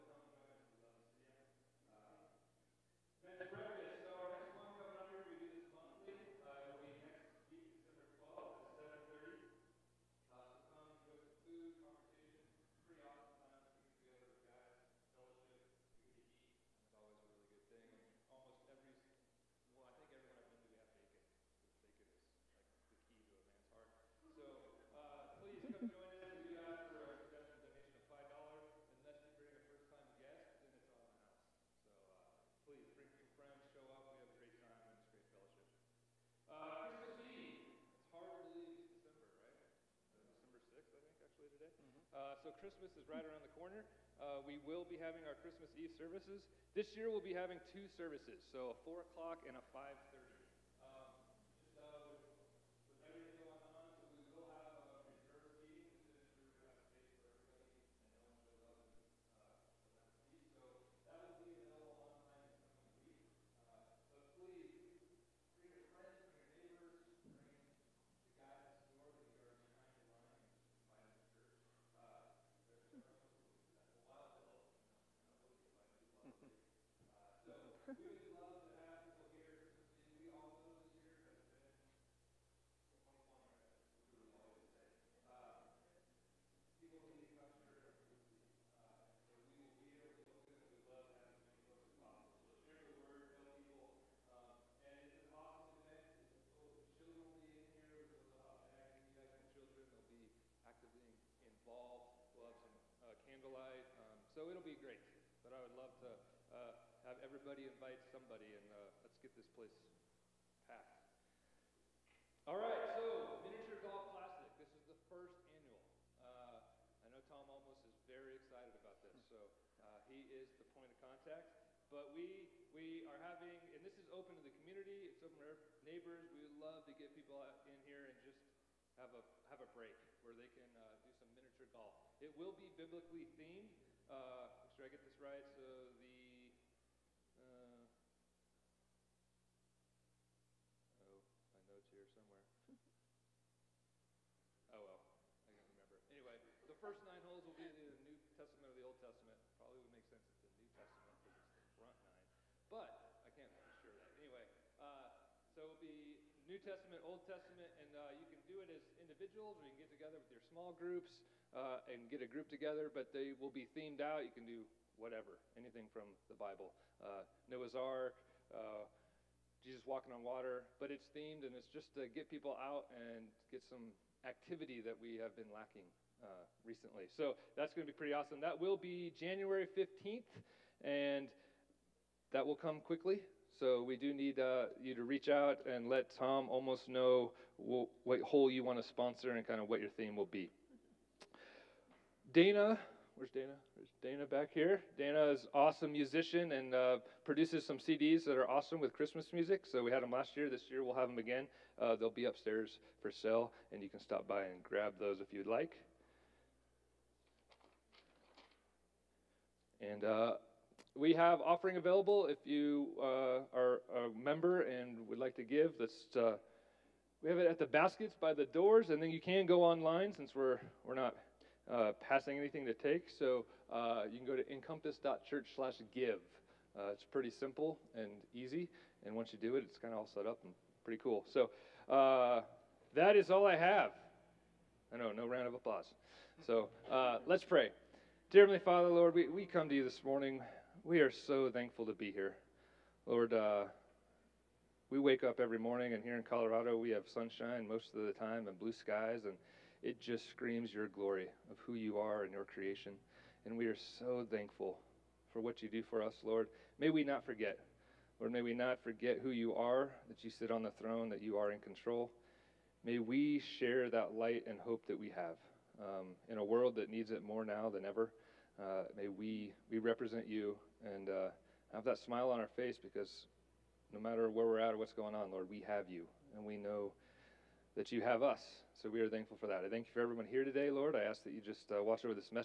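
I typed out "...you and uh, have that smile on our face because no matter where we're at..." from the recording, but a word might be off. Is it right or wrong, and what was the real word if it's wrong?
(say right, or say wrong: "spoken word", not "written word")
right.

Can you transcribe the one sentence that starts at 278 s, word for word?
So we are thankful for that.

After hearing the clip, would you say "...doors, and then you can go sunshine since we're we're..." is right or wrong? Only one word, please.
wrong.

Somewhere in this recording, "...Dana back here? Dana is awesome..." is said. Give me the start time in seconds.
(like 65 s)
194 s.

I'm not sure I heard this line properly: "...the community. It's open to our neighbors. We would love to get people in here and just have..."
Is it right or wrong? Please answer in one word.
right.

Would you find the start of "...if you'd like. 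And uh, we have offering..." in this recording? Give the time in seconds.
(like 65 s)
205 s.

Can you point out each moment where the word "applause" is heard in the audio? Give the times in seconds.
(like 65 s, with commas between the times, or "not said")
235 s.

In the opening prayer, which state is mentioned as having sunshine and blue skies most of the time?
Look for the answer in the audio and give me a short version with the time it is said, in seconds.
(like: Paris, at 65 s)
Colorado, at 246 s.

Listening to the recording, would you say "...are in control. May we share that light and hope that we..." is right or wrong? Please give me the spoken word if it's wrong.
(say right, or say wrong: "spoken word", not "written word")
right.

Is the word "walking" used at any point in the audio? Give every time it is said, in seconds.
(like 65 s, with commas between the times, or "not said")
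169 s.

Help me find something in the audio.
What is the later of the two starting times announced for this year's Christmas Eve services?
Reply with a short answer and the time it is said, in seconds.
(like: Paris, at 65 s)
5:30, at 49 s.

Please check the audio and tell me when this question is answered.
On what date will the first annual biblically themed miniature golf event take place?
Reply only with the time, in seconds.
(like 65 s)
179 s.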